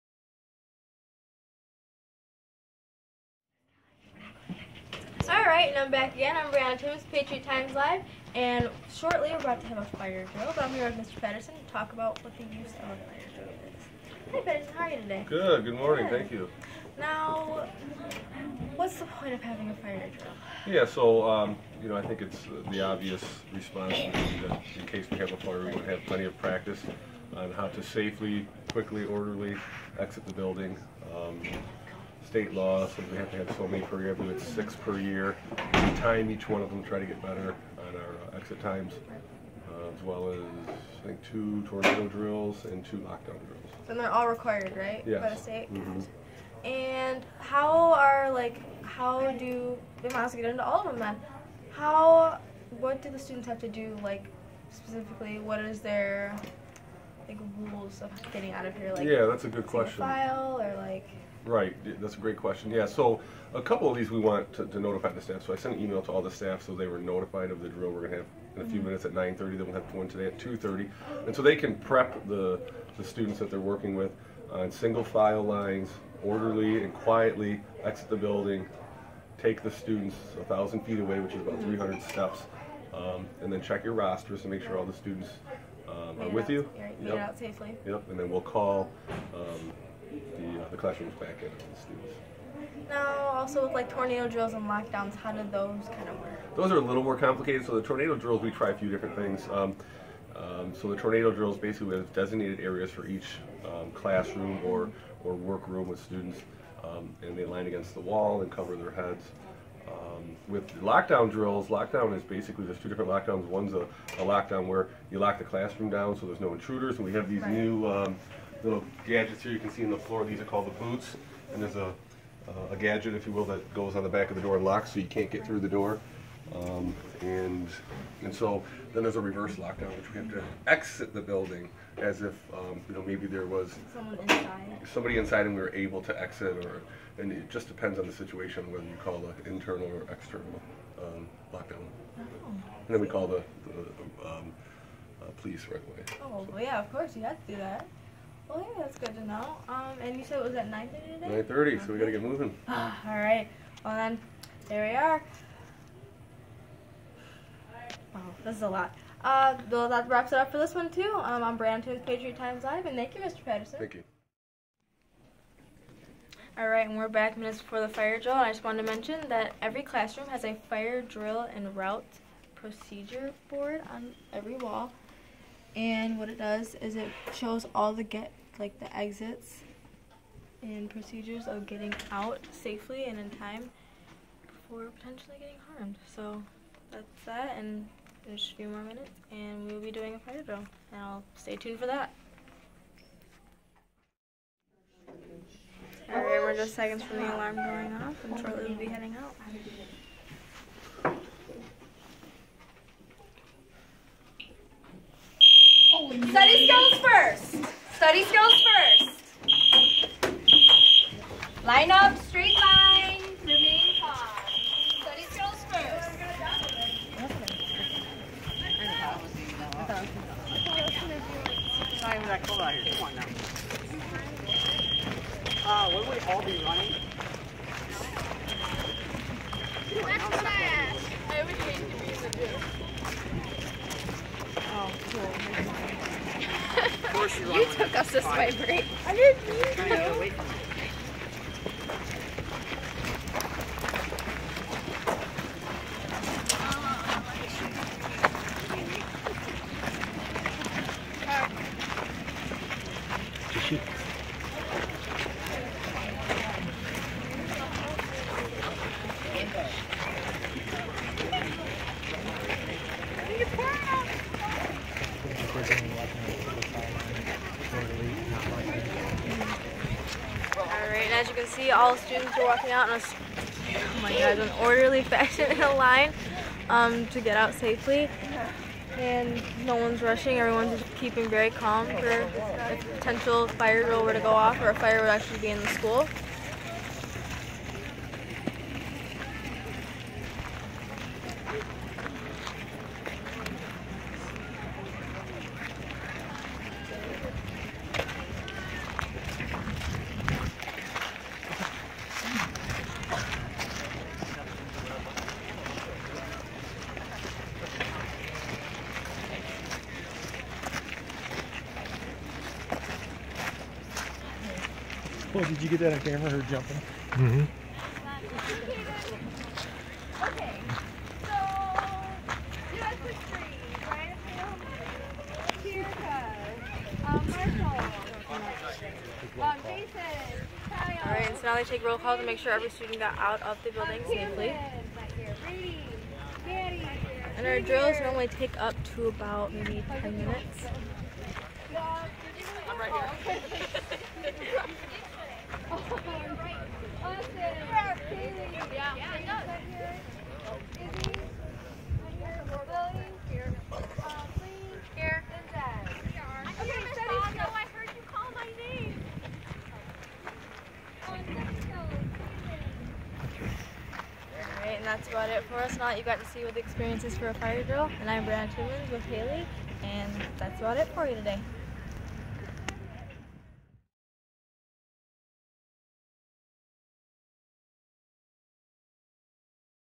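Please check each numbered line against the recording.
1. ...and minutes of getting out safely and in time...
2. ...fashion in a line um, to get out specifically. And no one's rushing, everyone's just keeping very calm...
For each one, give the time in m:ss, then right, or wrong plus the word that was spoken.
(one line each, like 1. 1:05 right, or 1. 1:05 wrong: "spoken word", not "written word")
1. 3:00 wrong: "procedures", not "minutes"
2. 4:35 wrong: "safely", not "specifically".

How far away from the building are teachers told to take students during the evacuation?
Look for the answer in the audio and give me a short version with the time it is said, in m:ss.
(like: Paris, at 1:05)
1,000 feet, at 1:20.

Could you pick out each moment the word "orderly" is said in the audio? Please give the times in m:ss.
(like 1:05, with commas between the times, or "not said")
0:29, 1:16, 4:34.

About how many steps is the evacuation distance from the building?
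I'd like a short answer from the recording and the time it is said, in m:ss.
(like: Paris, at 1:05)
300, at 1:21.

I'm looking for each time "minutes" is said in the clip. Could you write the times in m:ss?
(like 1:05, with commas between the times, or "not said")
1:08, 2:47, 3:08, 5:40.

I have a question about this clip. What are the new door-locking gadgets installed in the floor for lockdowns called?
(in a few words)
the boots.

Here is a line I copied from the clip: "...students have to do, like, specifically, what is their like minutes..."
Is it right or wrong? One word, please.
wrong.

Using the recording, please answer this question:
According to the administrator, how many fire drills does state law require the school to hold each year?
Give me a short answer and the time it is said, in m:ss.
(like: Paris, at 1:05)
6, at 0:34.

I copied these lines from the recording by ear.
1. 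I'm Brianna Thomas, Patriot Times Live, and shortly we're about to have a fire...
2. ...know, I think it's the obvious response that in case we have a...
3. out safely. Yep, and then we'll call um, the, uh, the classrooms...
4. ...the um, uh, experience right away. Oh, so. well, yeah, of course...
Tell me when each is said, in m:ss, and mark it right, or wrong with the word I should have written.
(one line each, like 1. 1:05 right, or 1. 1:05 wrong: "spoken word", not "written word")
1. 0:06 right
2. 0:21 right
3. 1:27 right
4. 2:23 wrong: "police", not "experience".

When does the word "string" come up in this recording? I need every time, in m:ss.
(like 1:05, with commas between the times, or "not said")
not said.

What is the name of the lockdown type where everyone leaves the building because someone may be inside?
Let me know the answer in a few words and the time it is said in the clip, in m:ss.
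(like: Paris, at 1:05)
reverse lockdown, at 2:09.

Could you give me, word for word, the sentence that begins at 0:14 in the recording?
Hey Patterson, how are you today?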